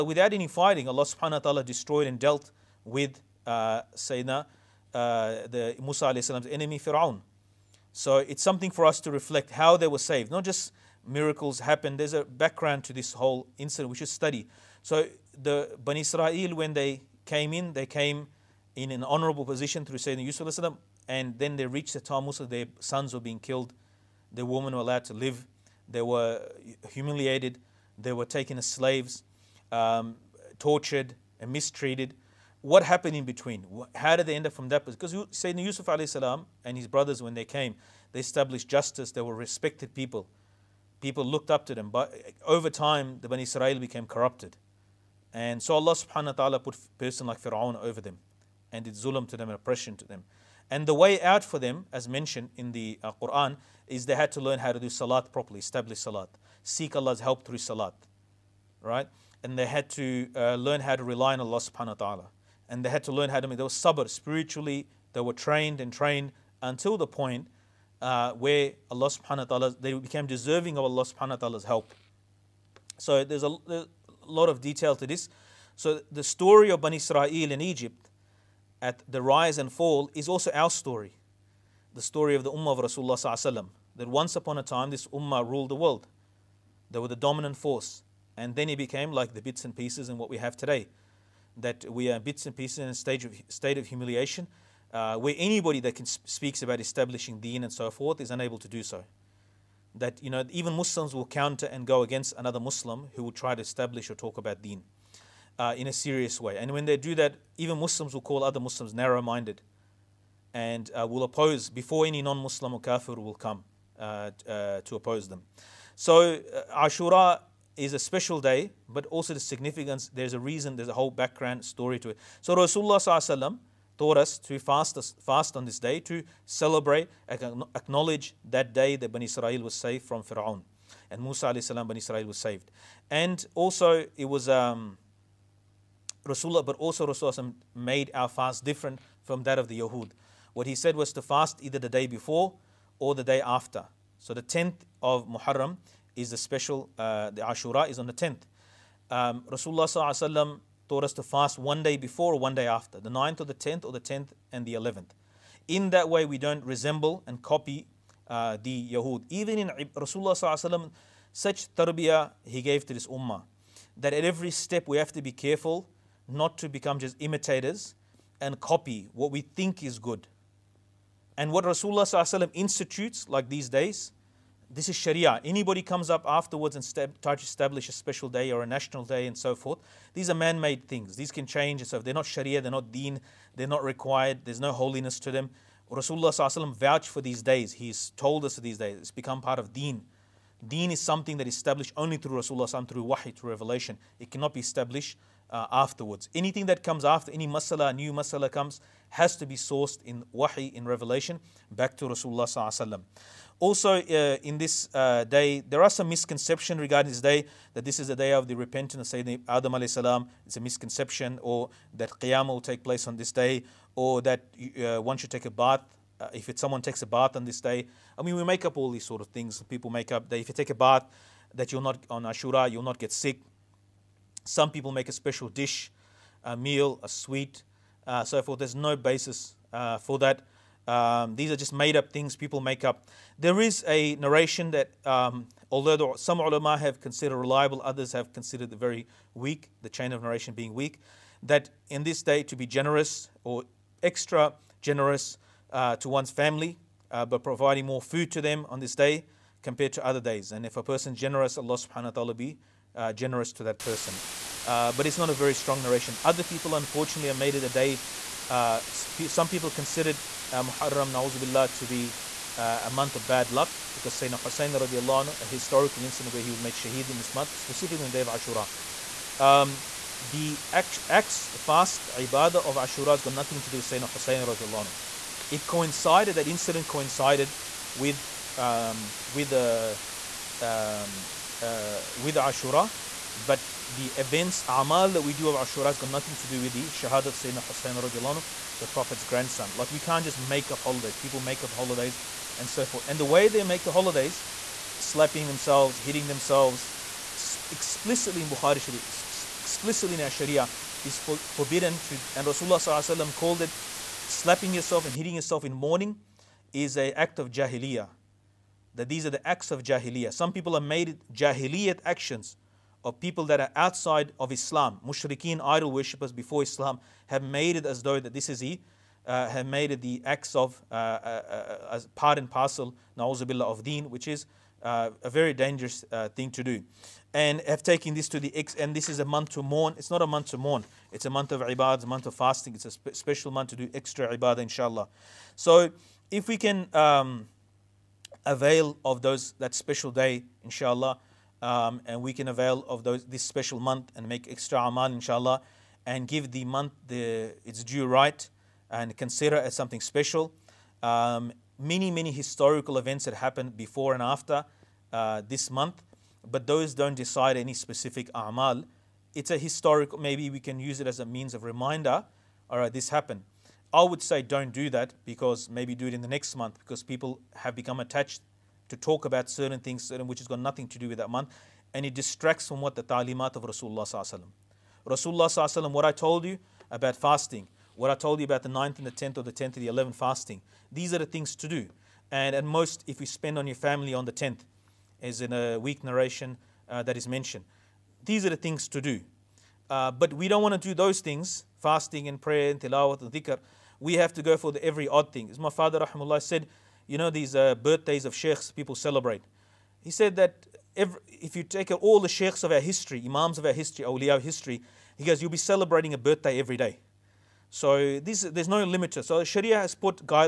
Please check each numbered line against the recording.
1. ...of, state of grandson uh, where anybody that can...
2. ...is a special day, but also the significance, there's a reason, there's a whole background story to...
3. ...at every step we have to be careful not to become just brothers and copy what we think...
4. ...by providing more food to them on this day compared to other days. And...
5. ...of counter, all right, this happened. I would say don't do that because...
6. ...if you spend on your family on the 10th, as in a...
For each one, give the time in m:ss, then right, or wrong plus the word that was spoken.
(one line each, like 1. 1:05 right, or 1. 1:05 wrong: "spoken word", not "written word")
1. 1:33 wrong: "humiliation", not "grandson"
2. 1:57 right
3. 2:44 wrong: "imitators", not "brothers"
4. 4:07 right
5. 6:01 wrong: "reminder", not "counter"
6. 6:23 right.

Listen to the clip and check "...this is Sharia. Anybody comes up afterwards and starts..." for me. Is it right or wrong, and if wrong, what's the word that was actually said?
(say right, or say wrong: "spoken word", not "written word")
right.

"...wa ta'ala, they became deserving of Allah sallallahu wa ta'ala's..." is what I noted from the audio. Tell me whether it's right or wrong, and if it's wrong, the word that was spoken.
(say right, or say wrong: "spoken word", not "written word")
wrong: "subhanahu", not "sallallahu".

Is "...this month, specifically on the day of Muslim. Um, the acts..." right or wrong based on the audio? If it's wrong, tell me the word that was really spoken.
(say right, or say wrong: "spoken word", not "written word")
wrong: "Ashura", not "Muslim".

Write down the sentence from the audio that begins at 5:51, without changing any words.
Um, many, many historical events that happened before and after uh, this month, but those don't decide any specific amal.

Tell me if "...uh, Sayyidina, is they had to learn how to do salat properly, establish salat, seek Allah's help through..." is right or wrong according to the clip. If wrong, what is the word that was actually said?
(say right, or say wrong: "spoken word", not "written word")
wrong: "Quran", not "Sayyidina".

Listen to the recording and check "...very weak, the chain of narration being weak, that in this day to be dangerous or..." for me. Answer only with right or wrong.
wrong.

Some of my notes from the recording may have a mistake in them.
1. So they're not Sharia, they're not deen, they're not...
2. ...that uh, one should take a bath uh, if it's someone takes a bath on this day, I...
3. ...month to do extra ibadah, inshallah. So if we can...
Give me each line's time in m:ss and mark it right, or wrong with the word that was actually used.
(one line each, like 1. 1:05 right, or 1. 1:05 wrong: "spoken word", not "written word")
1. 3:01 right
2. 3:34 right
3. 5:33 right.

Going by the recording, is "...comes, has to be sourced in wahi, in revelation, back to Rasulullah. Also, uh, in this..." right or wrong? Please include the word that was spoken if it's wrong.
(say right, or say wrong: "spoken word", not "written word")
right.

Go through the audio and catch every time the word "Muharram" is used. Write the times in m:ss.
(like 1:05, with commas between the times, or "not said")
2:25, 4:20.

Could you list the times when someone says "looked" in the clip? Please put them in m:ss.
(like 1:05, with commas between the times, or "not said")
0:41.